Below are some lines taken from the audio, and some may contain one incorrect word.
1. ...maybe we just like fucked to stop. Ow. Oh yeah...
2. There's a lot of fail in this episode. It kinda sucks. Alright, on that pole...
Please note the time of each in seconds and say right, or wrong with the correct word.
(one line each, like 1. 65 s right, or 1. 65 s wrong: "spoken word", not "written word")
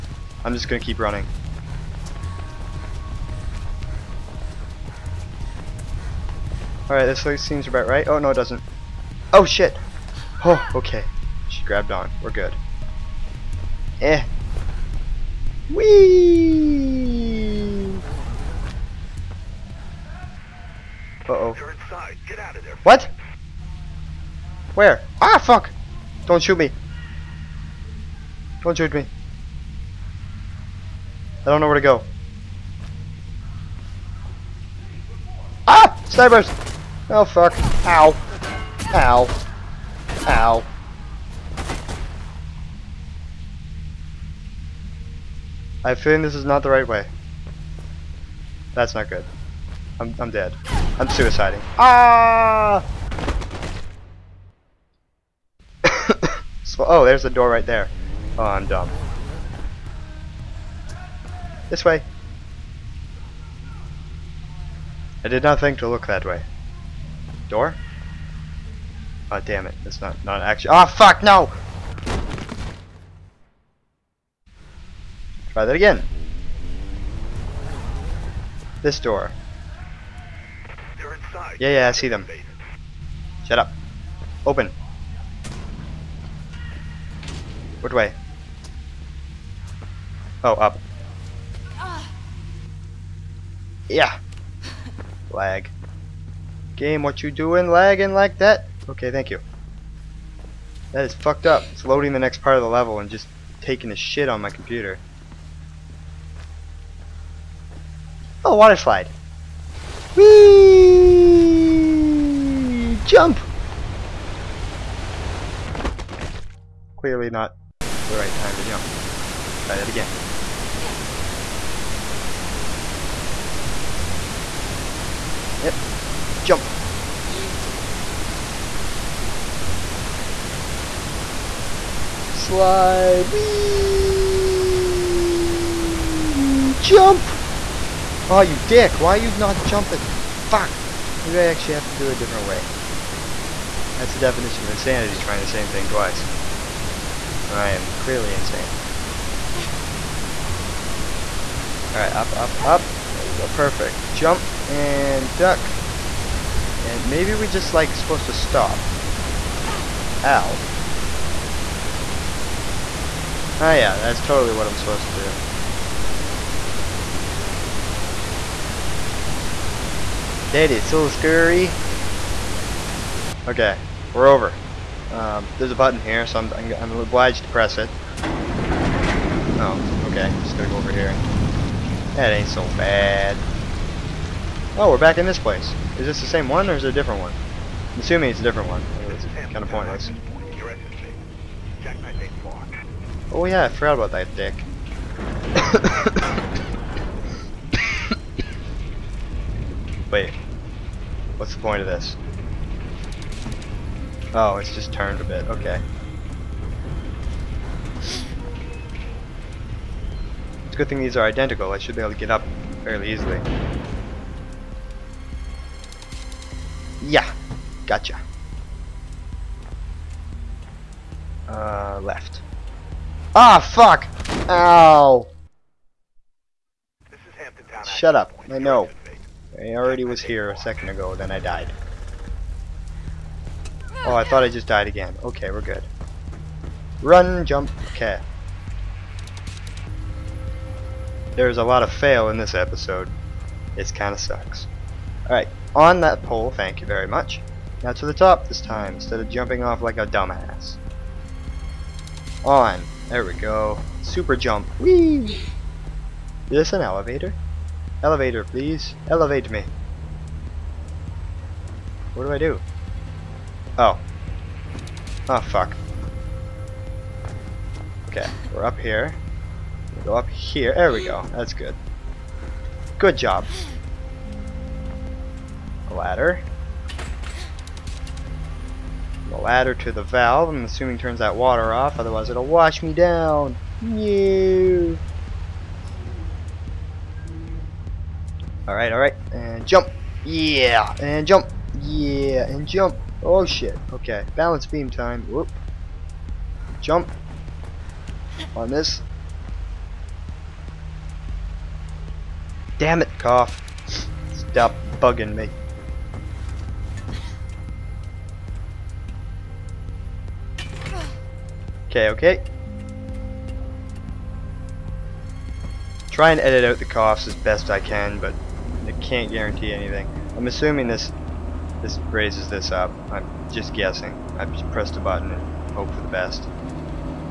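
1. 157 s wrong: "supposed", not "fucked"
2. 241 s right.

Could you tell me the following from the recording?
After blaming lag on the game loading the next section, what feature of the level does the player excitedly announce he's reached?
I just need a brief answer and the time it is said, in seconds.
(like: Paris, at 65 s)
water slide, at 108 s.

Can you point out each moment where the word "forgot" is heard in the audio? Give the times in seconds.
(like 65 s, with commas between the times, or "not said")
193 s.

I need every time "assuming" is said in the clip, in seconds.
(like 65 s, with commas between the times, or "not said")
187 s, 280 s, 320 s.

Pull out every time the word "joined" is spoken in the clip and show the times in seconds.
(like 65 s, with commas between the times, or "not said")
not said.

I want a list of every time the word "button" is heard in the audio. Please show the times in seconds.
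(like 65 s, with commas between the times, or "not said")
175 s, 324 s.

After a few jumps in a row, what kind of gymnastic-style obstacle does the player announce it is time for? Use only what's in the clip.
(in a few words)
balance beam.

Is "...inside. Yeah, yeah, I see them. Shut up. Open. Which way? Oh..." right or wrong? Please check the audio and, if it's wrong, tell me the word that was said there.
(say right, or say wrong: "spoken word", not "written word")
right.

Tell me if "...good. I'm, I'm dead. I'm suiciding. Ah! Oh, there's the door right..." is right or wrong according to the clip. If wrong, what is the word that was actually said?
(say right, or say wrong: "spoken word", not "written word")
right.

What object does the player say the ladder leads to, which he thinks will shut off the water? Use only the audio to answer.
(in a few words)
the valve.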